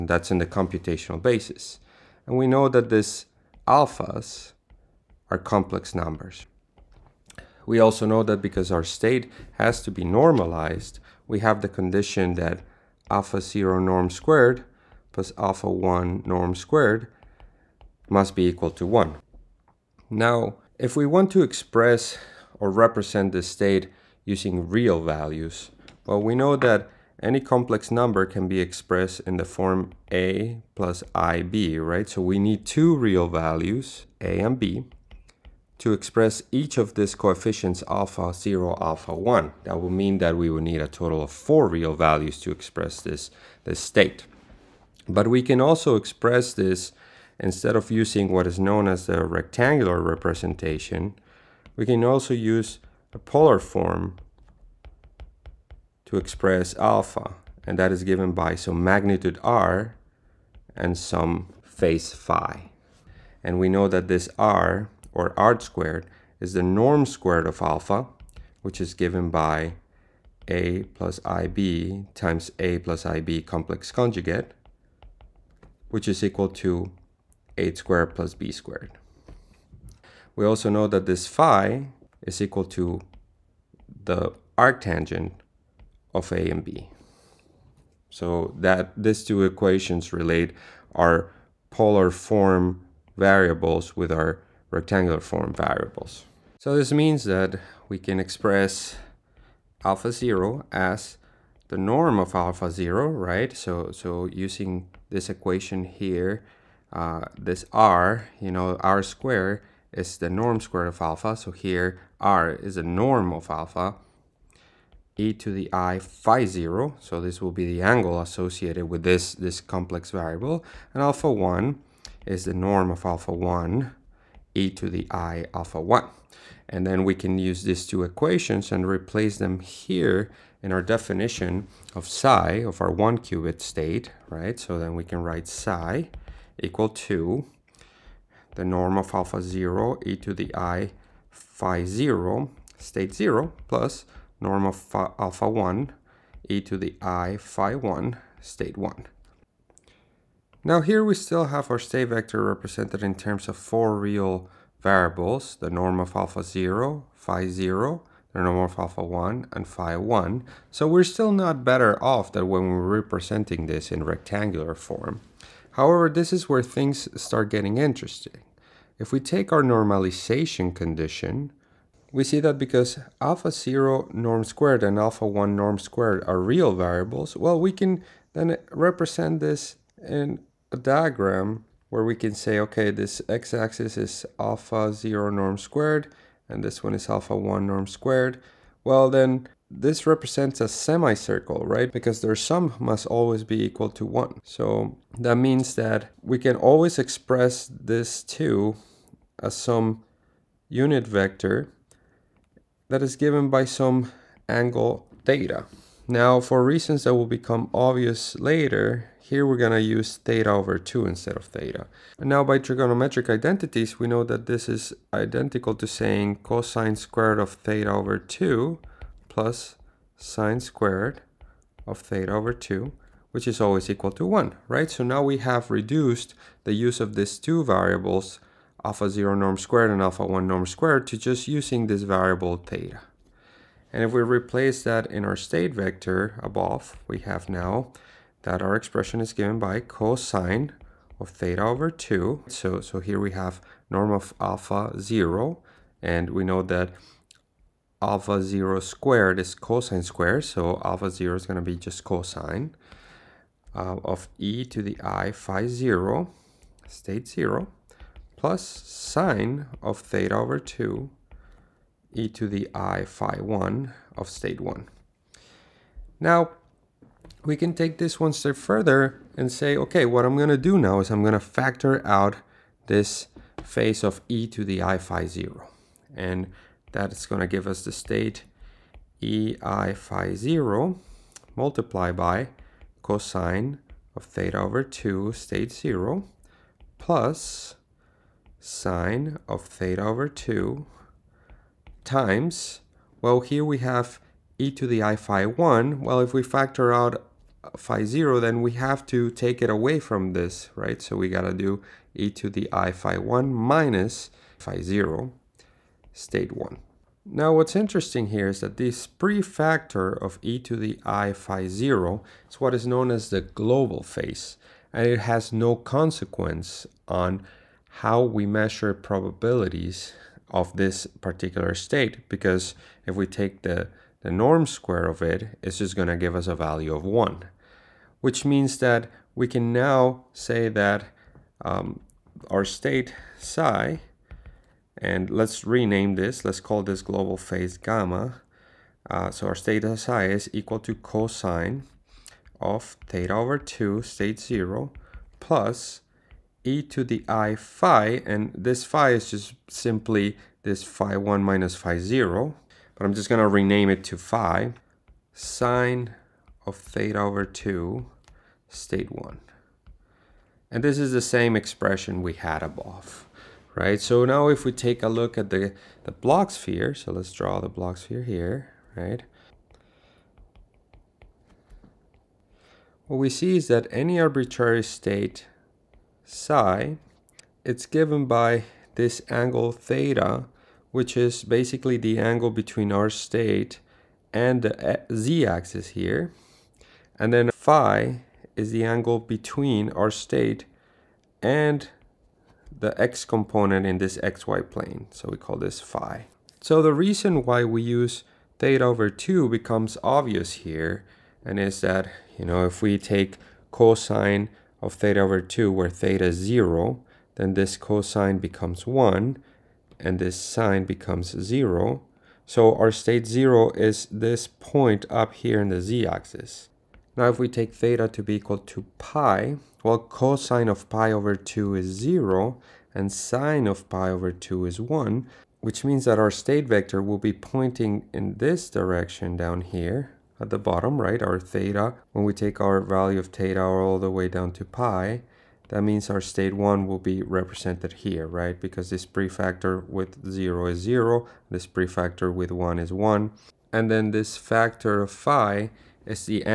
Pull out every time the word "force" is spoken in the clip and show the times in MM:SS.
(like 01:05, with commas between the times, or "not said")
not said.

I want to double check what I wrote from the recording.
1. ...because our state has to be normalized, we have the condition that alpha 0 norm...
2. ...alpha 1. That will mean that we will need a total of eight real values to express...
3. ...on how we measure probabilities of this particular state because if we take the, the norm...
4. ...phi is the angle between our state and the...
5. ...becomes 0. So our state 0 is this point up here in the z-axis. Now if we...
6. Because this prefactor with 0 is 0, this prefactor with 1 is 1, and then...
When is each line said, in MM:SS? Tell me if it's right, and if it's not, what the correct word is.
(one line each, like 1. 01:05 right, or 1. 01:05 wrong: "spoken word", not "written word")
1. 00:08 right
2. 00:38 wrong: "four", not "eight"
3. 05:17 right
4. 06:27 right
5. 06:50 right
6. 07:18 right.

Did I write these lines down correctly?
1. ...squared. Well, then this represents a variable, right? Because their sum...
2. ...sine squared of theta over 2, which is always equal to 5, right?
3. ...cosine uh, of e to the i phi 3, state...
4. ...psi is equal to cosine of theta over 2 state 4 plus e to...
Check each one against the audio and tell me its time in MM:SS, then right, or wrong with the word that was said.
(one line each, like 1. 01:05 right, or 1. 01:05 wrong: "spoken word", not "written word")
1. 03:07 wrong: "semicircle", not "variable"
2. 03:40 wrong: "1", not "5"
3. 04:12 wrong: "0", not "3"
4. 05:39 wrong: "0", not "4".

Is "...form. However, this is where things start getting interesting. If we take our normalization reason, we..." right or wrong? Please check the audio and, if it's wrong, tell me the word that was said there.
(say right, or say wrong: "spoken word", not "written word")
wrong: "condition", not "reason".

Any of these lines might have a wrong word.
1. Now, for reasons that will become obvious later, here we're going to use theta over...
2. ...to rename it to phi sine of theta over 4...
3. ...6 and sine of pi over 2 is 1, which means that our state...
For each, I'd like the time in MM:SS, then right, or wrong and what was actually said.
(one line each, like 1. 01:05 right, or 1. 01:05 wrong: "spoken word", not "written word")
1. 03:26 right
2. 05:53 wrong: "2", not "4"
3. 07:01 wrong: "0", not "6".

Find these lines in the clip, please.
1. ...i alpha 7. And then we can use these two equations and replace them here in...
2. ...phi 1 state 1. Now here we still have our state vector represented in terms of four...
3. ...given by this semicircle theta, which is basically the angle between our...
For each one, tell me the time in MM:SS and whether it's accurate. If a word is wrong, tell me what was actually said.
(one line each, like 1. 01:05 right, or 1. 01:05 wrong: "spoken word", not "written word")
1. 02:05 wrong: "1", not "7"
2. 02:27 right
3. 06:17 wrong: "angle", not "semicircle".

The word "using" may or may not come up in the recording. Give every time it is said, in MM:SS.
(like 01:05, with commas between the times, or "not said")
00:24, 00:47, 01:44, 03:51.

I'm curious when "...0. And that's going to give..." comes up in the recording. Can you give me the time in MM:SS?
04:35.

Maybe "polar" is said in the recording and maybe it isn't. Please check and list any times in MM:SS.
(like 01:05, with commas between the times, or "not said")
00:53, 01:31.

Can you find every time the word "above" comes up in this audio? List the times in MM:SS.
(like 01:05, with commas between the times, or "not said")
03:56, 06:02.